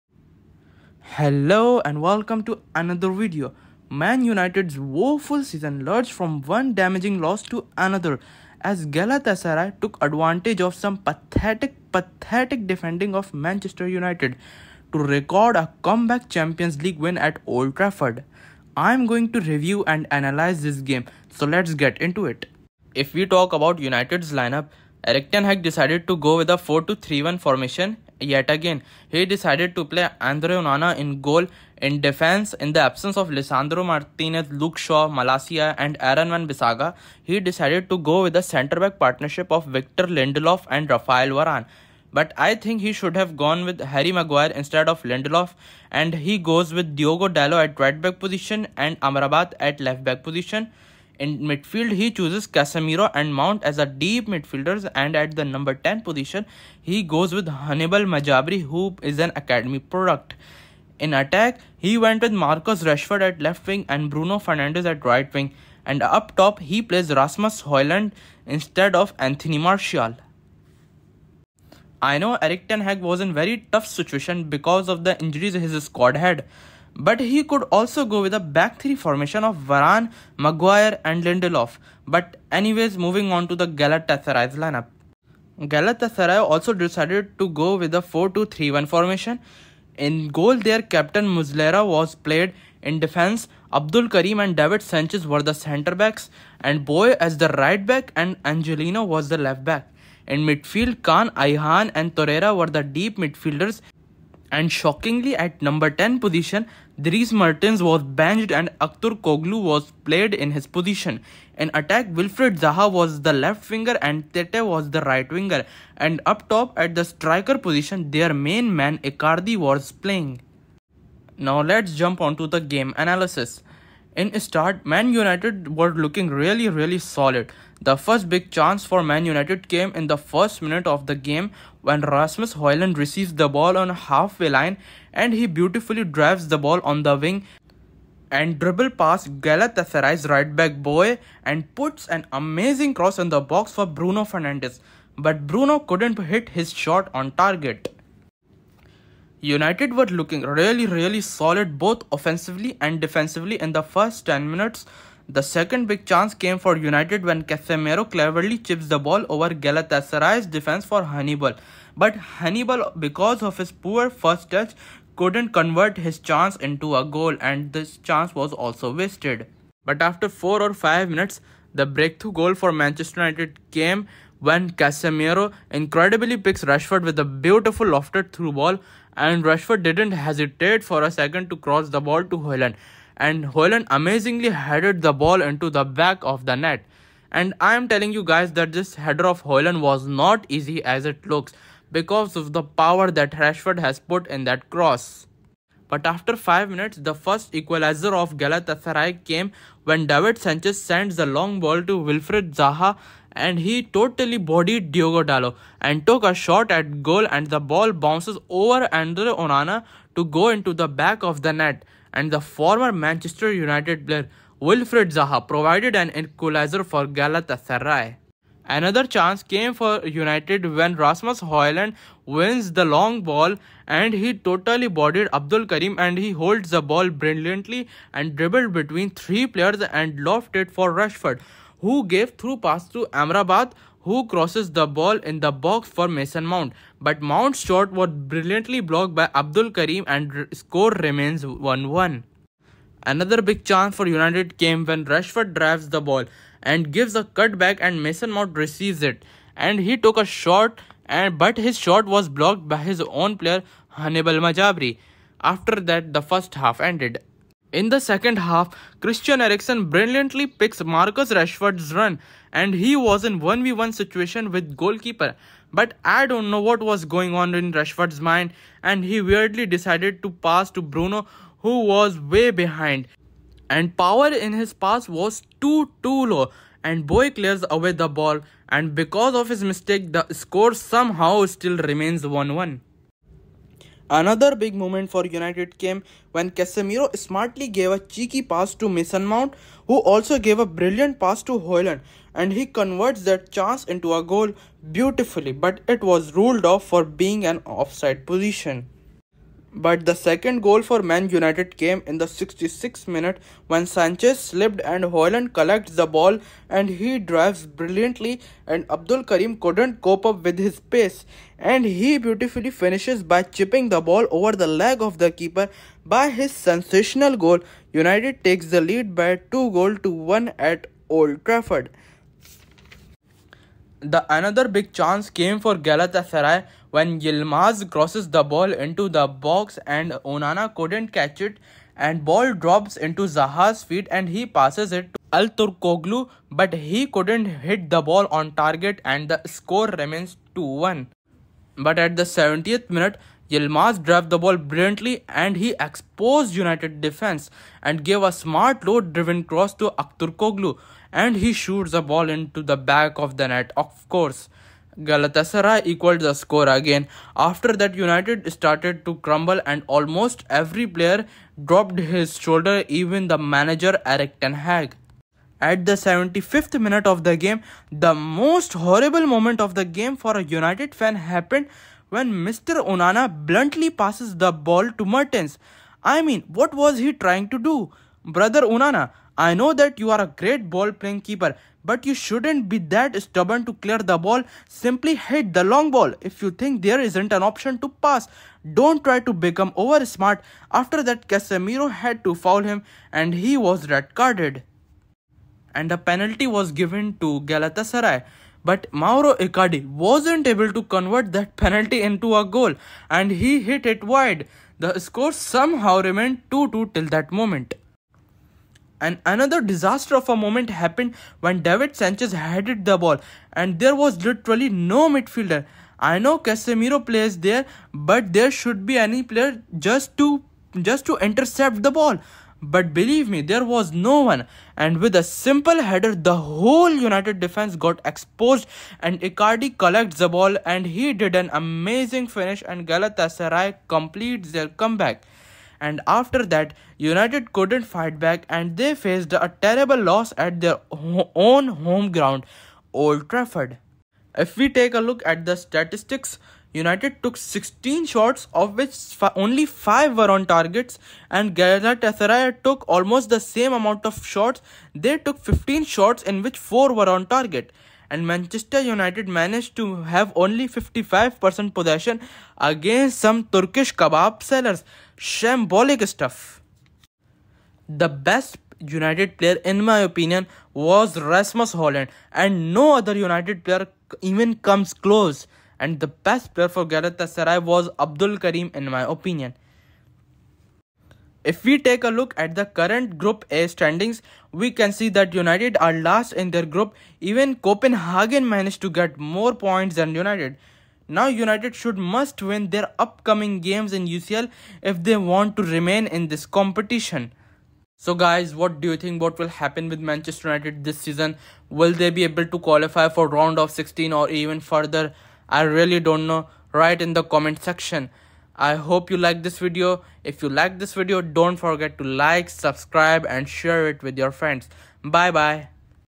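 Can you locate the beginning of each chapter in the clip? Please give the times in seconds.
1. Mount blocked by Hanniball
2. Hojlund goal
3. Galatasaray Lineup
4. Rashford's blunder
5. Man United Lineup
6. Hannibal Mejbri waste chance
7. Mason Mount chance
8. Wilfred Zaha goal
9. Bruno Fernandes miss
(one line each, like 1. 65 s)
1. 242 s
2. 170 s
3. 85 s
4. 257 s
5. 22 s
6. 155 s
7. 218 s
8. 196 s
9. 124 s.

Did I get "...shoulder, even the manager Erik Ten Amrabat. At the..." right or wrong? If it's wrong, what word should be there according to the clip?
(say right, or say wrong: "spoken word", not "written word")
wrong: "Hag", not "Amrabat".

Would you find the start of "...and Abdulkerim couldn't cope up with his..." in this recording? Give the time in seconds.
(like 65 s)
308 s.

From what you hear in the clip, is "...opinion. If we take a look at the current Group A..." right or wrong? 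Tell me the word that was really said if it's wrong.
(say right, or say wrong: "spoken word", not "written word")
right.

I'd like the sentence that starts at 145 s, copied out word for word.
But Bruno couldn't hit his shot on target.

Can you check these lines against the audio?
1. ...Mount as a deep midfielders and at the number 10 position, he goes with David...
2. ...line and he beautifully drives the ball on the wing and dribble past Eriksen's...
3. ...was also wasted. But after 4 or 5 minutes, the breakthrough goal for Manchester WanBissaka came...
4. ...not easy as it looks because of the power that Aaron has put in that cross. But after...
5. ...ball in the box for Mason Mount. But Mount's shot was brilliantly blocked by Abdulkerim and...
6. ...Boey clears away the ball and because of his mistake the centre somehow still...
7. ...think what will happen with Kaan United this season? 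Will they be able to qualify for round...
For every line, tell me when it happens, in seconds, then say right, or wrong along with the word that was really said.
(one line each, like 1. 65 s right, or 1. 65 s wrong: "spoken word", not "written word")
1. 53 s wrong: "Hannibal", not "David"
2. 134 s wrong: "Galatasaray", not "Eriksen"
3. 168 s wrong: "United", not "WanBissaka"
4. 190 s wrong: "Rashford", not "Aaron"
5. 234 s right
6. 277 s wrong: "score", not "centre"
7. 498 s wrong: "Manchester", not "Kaan".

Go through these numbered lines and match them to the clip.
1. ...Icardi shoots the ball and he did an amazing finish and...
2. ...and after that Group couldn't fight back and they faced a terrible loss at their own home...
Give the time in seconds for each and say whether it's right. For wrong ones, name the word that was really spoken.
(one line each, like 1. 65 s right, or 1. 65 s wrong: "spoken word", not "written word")
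1. 429 s wrong: "collects", not "shoots"
2. 435 s wrong: "United", not "Group".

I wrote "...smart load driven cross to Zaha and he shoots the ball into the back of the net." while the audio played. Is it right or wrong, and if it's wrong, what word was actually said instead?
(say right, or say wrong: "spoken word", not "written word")
wrong: "Akturkoglu", not "Zaha".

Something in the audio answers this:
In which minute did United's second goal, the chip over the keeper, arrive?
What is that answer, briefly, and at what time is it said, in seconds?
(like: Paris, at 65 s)
66th, at 302 s.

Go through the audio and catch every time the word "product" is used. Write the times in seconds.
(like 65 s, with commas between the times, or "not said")
59 s.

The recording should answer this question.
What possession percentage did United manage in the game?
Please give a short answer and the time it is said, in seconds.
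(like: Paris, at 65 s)
55%, at 460 s.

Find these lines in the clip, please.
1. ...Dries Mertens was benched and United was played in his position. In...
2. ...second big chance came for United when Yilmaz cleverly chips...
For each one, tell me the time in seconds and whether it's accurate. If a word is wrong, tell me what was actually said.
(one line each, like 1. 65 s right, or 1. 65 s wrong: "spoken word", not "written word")
1. 107 s wrong: "Akturkoglu", not "United"
2. 155 s wrong: "Casemiro", not "Yilmaz".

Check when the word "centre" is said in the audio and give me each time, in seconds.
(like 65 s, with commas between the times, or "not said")
38 s, 95 s.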